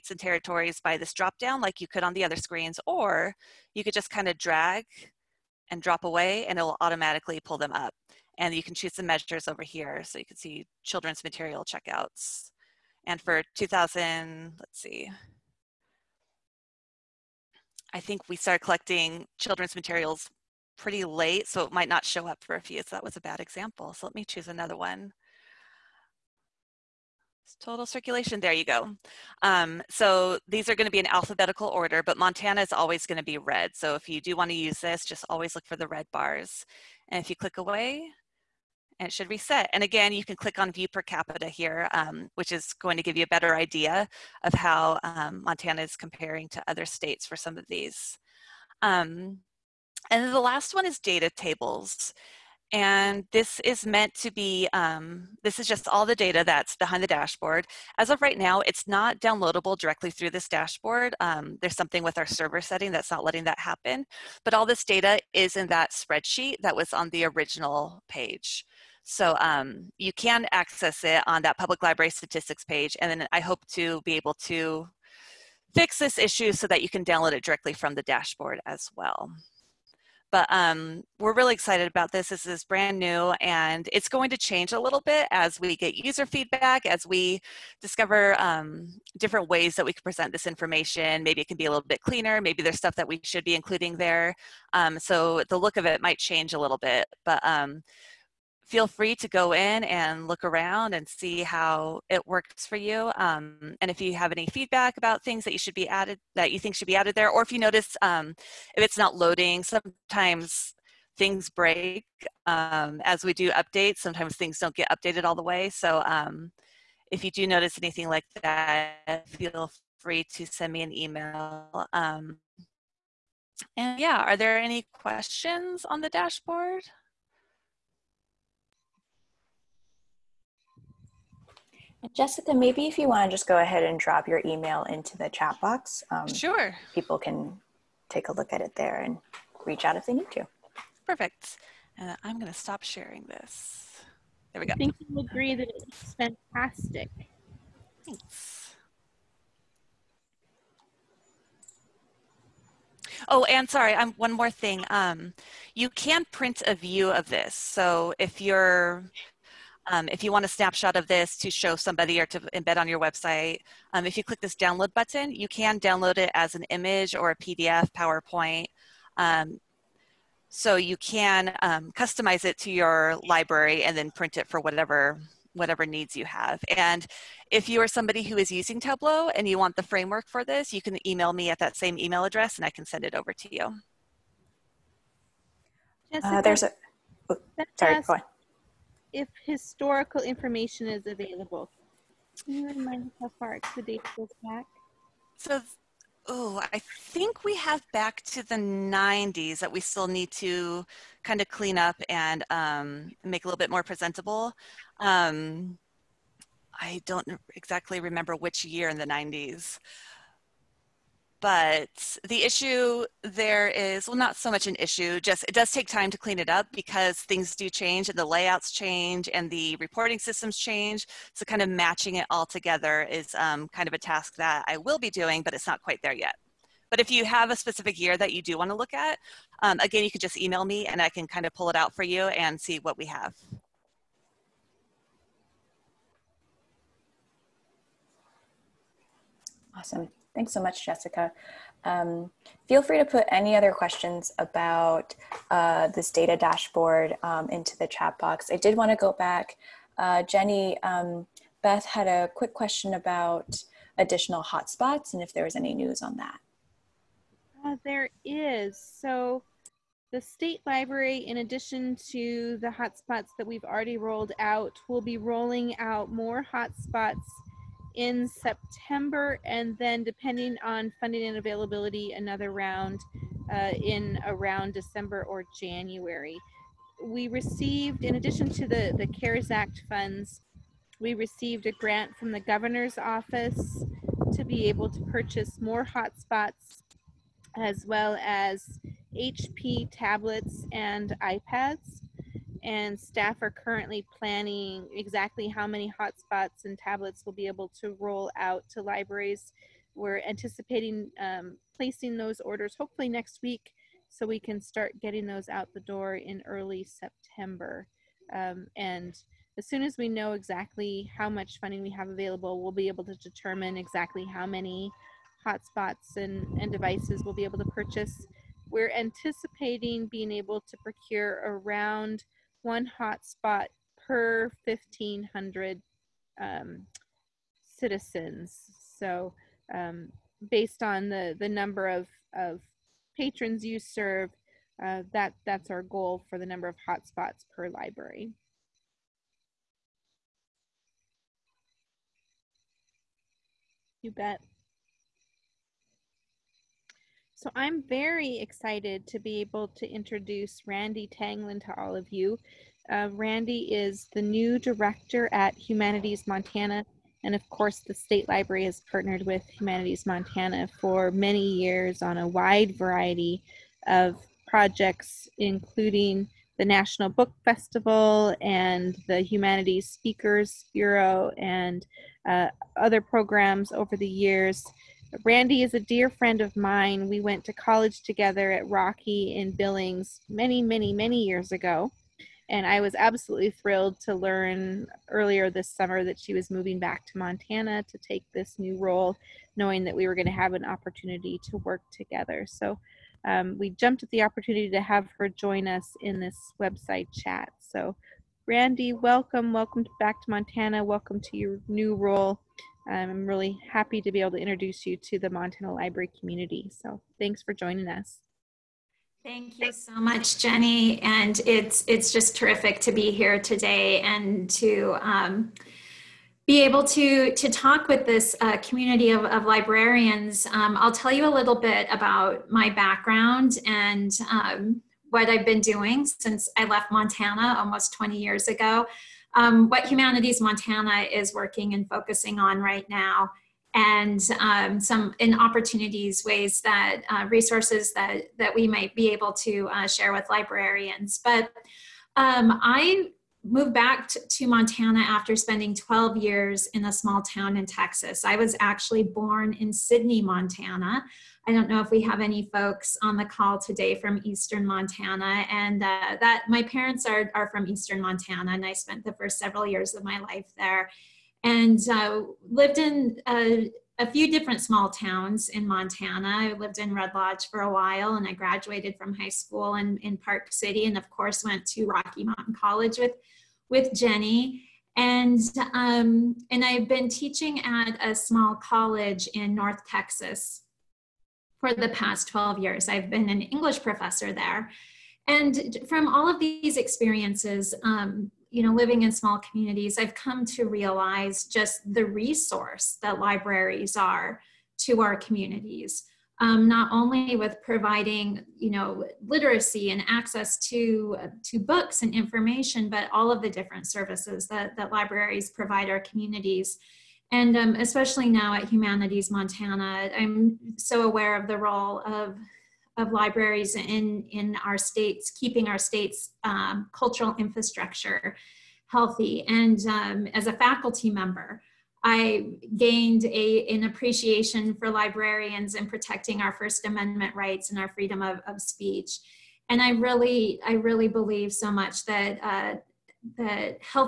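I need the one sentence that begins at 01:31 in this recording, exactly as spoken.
Maybe it can be a little bit cleaner.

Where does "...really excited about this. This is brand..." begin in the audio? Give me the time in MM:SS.
01:21.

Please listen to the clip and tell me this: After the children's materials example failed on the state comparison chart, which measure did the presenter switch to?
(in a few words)
Total circulation.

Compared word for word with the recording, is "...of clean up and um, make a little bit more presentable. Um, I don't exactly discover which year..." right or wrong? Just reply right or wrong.
wrong.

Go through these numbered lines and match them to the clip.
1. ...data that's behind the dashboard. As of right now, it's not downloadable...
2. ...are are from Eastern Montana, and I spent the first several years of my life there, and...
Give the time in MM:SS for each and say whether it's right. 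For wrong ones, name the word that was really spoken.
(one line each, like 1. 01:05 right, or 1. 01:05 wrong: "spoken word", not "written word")
1. 00:56 right
2. 07:37 right.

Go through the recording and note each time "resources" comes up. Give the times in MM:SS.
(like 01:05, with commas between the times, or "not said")
07:17, 08:12.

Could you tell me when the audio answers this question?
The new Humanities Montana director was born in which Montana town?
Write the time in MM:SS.
07:29.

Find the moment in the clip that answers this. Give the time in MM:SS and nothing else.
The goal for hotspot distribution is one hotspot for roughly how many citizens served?
05:24.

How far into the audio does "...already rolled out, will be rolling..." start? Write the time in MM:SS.
04:23.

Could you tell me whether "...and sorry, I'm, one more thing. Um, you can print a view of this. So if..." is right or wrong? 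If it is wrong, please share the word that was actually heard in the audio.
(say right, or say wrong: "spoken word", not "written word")
right.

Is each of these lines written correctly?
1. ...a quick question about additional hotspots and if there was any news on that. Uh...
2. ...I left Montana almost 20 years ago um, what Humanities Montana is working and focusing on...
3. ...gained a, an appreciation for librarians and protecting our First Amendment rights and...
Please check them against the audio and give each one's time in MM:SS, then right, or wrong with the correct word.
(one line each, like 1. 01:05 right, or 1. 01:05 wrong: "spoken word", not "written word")
1. 04:12 right
2. 07:06 right
3. 08:42 right.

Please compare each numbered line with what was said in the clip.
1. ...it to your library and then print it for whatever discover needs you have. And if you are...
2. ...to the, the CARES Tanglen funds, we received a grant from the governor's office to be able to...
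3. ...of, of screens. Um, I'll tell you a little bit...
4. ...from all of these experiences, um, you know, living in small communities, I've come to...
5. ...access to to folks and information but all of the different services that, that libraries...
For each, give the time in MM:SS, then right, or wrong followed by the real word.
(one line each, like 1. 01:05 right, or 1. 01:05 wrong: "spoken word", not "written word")
1. 02:52 wrong: "whatever", not "discover"
2. 04:38 wrong: "Act", not "Tanglen"
3. 06:59 wrong: "librarians", not "screens"
4. 08:05 right
5. 08:20 wrong: "books", not "folks".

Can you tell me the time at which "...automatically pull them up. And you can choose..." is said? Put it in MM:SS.
00:06.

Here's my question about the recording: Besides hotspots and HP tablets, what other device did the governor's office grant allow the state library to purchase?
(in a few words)
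iPads.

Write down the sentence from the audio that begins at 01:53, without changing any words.
Sometimes things don't get updated all the way.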